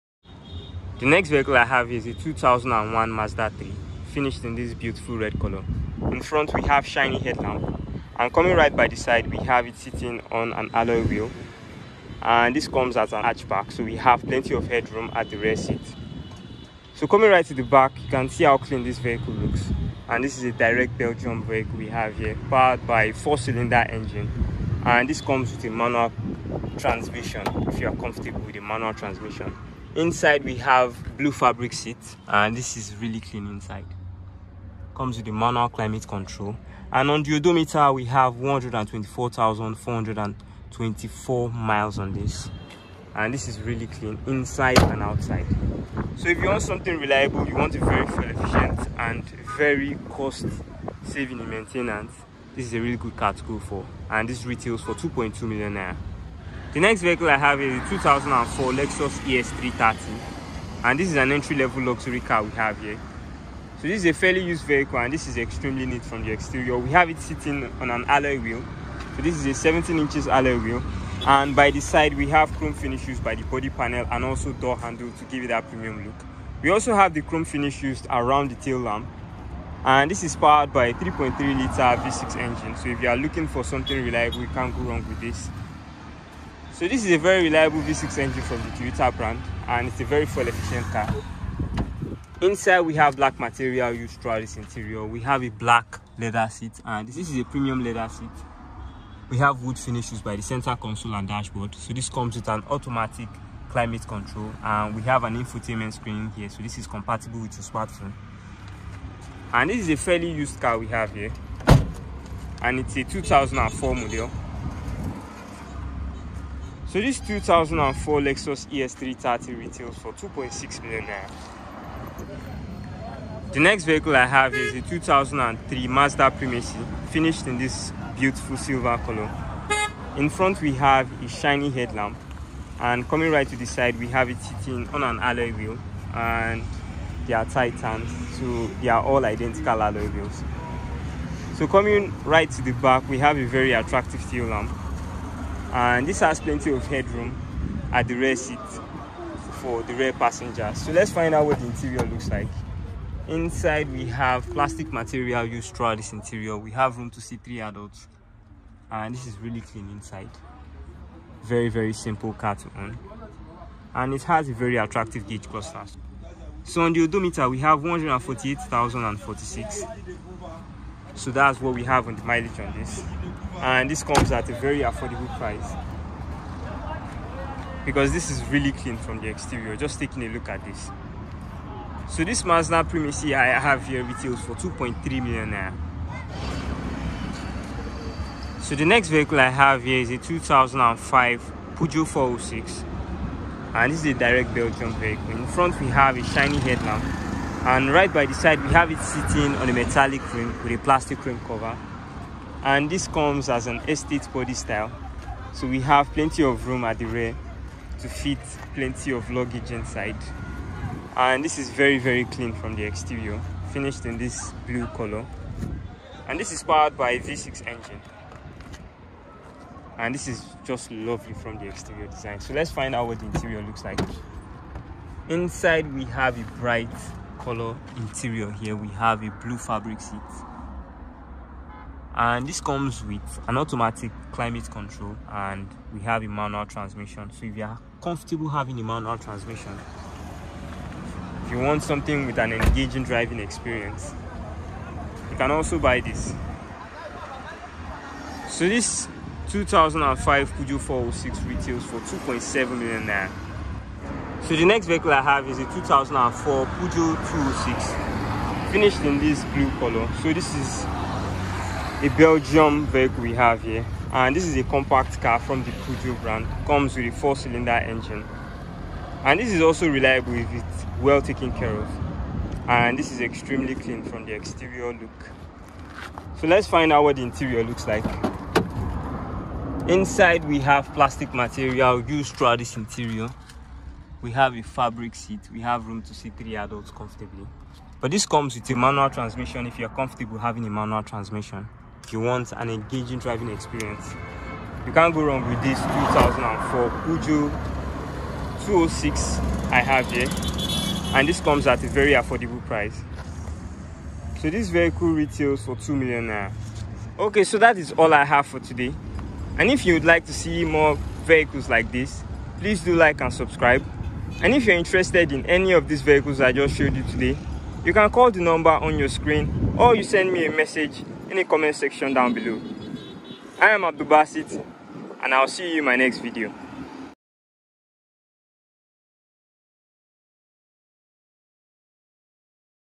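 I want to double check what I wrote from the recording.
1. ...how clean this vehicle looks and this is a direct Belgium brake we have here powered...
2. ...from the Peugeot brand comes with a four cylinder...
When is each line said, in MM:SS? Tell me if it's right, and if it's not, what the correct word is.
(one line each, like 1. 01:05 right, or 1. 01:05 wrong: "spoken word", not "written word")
1. 00:18 right
2. 04:25 right.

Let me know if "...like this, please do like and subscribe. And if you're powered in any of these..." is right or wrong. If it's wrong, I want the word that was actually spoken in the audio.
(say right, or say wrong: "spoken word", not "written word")
wrong: "interested", not "powered".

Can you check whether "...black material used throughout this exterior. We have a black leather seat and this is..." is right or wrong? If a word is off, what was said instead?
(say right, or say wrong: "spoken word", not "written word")
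wrong: "interior", not "exterior".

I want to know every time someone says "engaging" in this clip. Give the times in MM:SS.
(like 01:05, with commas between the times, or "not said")
04:02, 04:52.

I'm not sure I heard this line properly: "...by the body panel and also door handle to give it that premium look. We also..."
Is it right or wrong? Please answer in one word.
right.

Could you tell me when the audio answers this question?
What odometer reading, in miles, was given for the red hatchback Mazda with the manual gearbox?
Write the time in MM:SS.
00:38.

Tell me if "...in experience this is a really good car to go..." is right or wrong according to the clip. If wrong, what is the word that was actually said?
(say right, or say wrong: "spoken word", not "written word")
wrong: "maintenance", not "experience".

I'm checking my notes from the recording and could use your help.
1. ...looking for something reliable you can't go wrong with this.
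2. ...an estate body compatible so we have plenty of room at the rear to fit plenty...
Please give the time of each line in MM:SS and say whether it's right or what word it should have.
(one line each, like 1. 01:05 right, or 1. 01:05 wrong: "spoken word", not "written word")
1. 01:23 right
2. 03:23 wrong: "style", not "compatible".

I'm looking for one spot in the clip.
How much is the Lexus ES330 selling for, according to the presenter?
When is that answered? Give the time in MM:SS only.
02:00.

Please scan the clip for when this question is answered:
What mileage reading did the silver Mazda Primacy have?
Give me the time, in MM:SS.
02:47.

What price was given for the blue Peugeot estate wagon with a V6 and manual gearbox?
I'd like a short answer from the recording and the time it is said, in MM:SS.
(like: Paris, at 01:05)
2.7 million naira, at 04:11.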